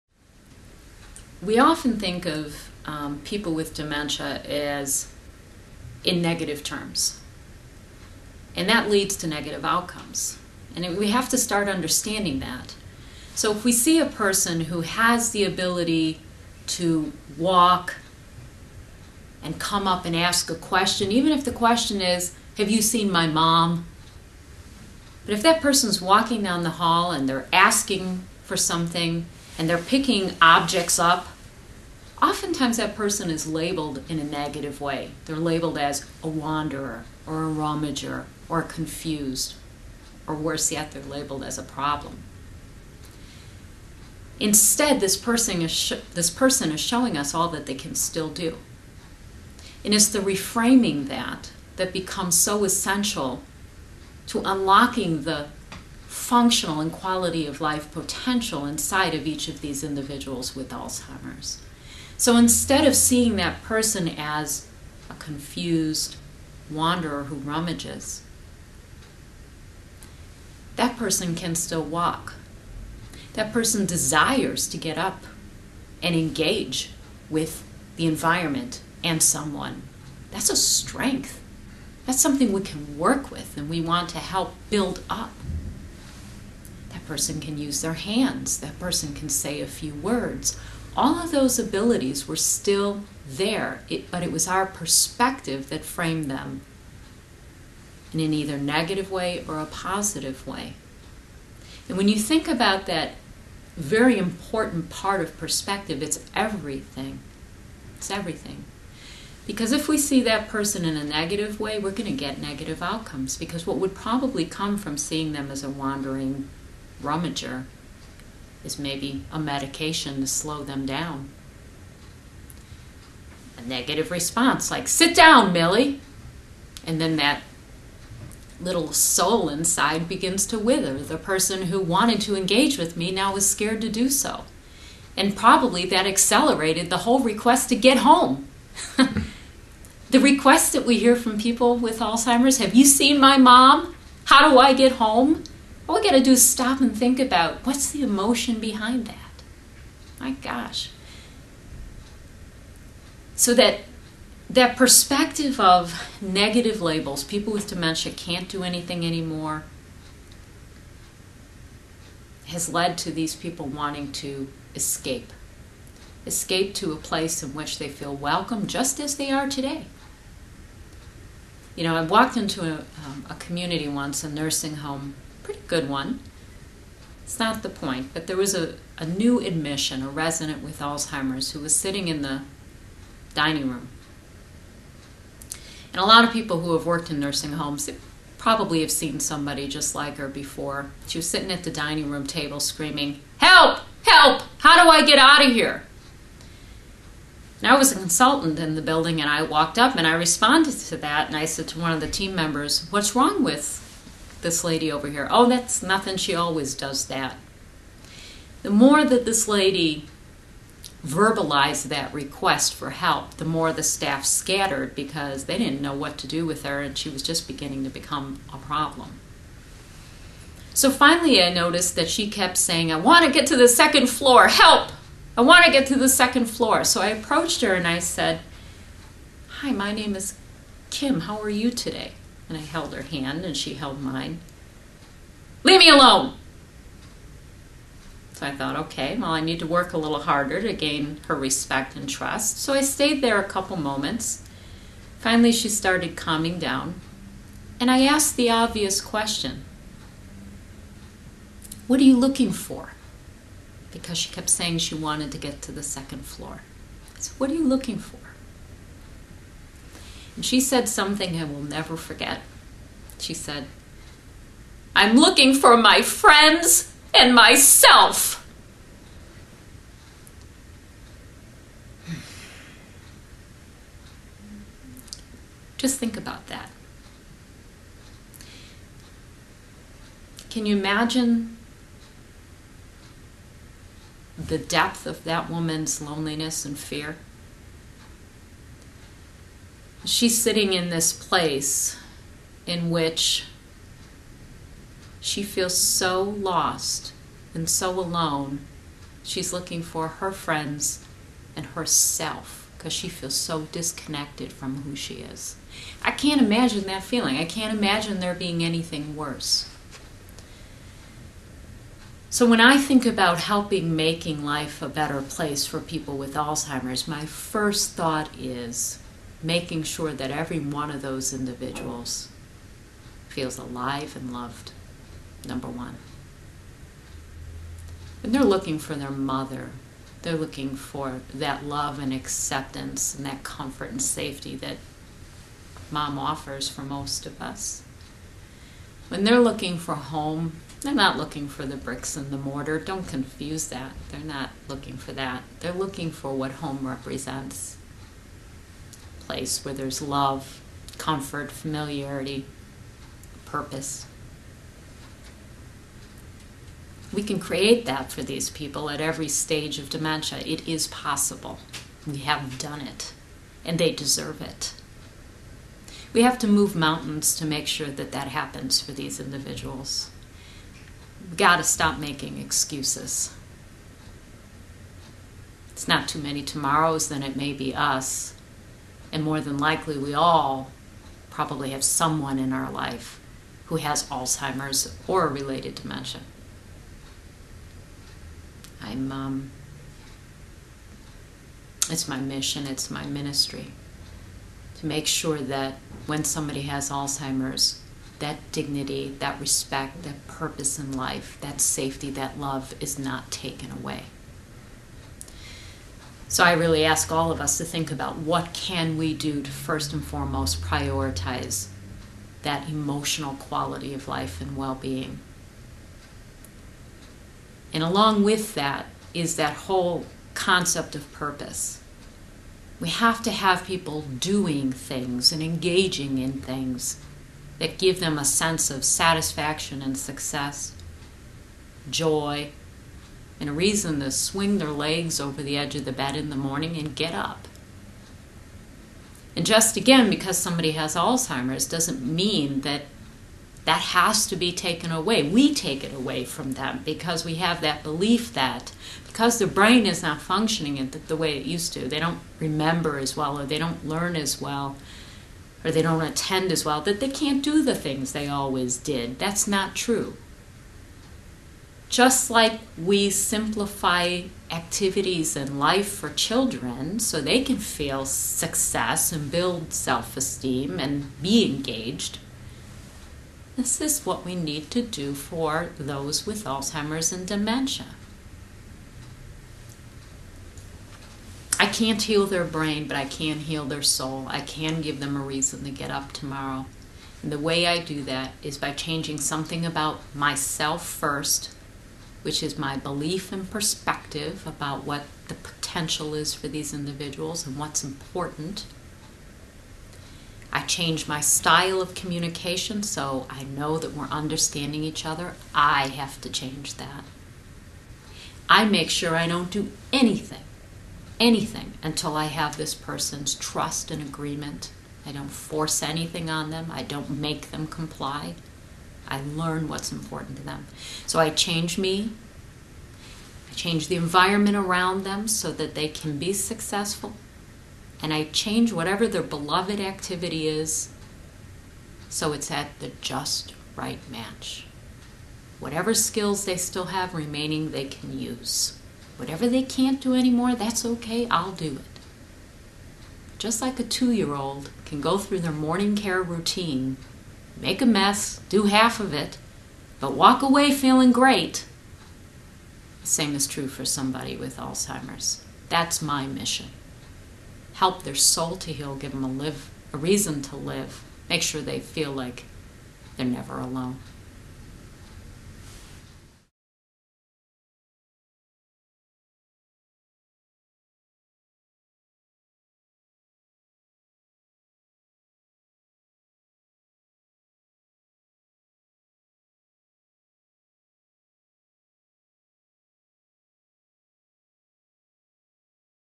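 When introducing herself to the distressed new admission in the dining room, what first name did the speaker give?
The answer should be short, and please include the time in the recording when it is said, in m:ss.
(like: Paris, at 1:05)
Kim, at 3:50.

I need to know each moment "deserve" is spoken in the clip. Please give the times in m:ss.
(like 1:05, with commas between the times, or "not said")
6:03.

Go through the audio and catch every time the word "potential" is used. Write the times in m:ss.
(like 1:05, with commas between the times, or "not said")
0:57, 8:15.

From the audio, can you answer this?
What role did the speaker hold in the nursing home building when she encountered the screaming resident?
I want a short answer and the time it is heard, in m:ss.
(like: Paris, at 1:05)
Consultant, at 3:17.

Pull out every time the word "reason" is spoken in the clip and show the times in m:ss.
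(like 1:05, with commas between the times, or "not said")
7:13, 8:05, 9:19.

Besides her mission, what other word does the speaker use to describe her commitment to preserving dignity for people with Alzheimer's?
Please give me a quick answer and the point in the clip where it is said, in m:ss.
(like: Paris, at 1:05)
Ministry, at 6:33.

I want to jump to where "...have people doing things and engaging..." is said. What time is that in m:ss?
7:03.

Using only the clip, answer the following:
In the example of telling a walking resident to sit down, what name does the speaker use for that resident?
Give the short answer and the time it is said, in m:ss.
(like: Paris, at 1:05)
Millie, at 2:05.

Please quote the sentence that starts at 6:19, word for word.
And more than likely, we all probably have someone in our life who has Alzheimer's or related dementia.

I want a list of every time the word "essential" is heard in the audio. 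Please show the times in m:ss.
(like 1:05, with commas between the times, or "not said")
0:52.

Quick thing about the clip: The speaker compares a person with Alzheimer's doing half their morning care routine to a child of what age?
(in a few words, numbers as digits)
2.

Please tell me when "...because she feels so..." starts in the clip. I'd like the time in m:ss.
5:02.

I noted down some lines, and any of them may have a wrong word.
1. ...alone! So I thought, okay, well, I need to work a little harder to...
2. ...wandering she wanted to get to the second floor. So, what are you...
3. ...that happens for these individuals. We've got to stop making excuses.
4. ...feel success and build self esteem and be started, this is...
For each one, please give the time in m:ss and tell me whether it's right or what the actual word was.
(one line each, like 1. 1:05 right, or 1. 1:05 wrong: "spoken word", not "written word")
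1. 3:55 right
2. 4:14 wrong: "saying", not "wandering"
3. 6:08 right
4. 7:47 wrong: "engaged", not "started".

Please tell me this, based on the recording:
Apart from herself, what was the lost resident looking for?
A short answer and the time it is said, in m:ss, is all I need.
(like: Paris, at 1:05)
Her friends, at 4:25.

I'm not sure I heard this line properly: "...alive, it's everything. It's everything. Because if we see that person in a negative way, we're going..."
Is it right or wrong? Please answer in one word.
wrong.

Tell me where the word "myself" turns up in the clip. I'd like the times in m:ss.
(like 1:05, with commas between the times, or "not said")
4:27, 8:10.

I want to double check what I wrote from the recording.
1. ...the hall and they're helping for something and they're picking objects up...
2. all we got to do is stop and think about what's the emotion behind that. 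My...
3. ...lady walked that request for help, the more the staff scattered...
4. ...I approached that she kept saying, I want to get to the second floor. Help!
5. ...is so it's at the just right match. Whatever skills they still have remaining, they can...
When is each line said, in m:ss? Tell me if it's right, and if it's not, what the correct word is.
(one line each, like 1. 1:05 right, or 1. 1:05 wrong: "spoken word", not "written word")
1. 0:26 wrong: "asking", not "helping"
2. 2:25 right
3. 3:29 wrong: "verbalized", not "walked"
4. 3:41 wrong: "noticed", not "approached"
5. 8:50 right.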